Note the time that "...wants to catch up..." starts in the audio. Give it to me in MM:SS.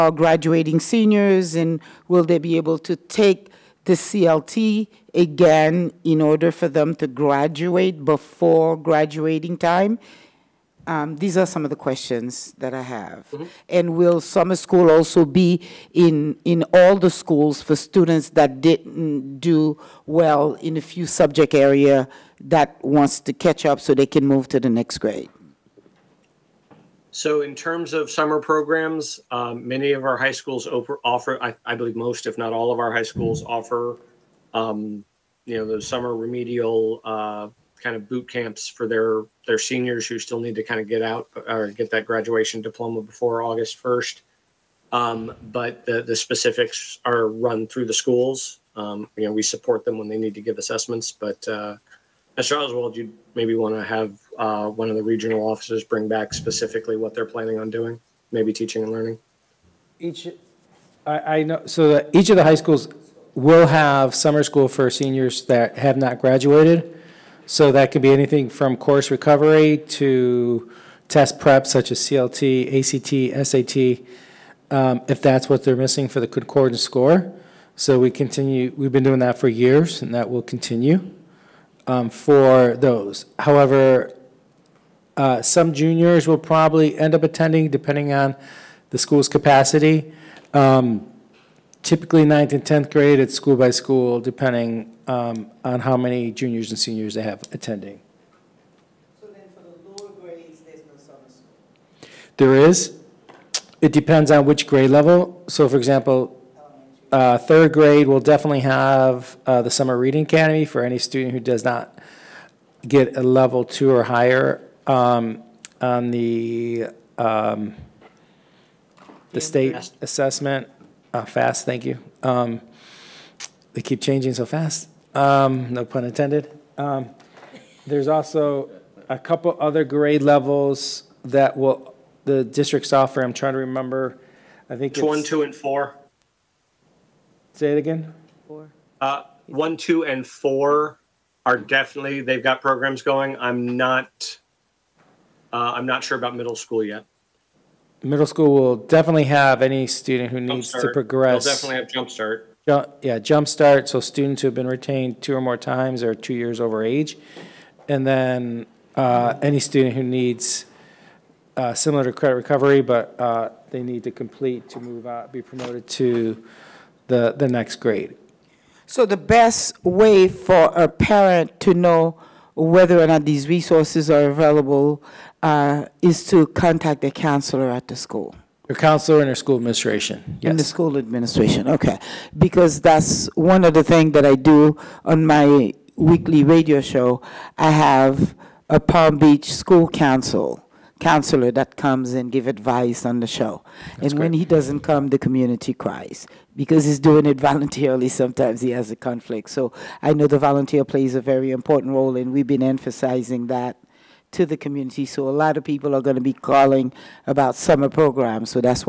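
00:22.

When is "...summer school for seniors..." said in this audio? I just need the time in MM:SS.
01:04.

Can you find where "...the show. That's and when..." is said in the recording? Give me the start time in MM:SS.
03:13.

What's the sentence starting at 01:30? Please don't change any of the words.
Um, typically, ninth and 10th grade, it's school by school, depending um, on how many juniors and seniors they have attending.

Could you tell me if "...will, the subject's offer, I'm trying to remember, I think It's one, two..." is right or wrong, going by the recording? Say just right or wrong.
wrong.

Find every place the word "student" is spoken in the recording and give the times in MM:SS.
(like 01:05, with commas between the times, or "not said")
00:17, 01:50, 02:29, 02:33, 02:39.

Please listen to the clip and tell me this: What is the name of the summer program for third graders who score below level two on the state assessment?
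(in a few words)
Summer Reading Academy.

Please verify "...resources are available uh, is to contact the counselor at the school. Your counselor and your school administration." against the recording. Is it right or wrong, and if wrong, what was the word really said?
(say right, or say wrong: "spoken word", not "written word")
right.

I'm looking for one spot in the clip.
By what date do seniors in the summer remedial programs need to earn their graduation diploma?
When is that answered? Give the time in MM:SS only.
00:43.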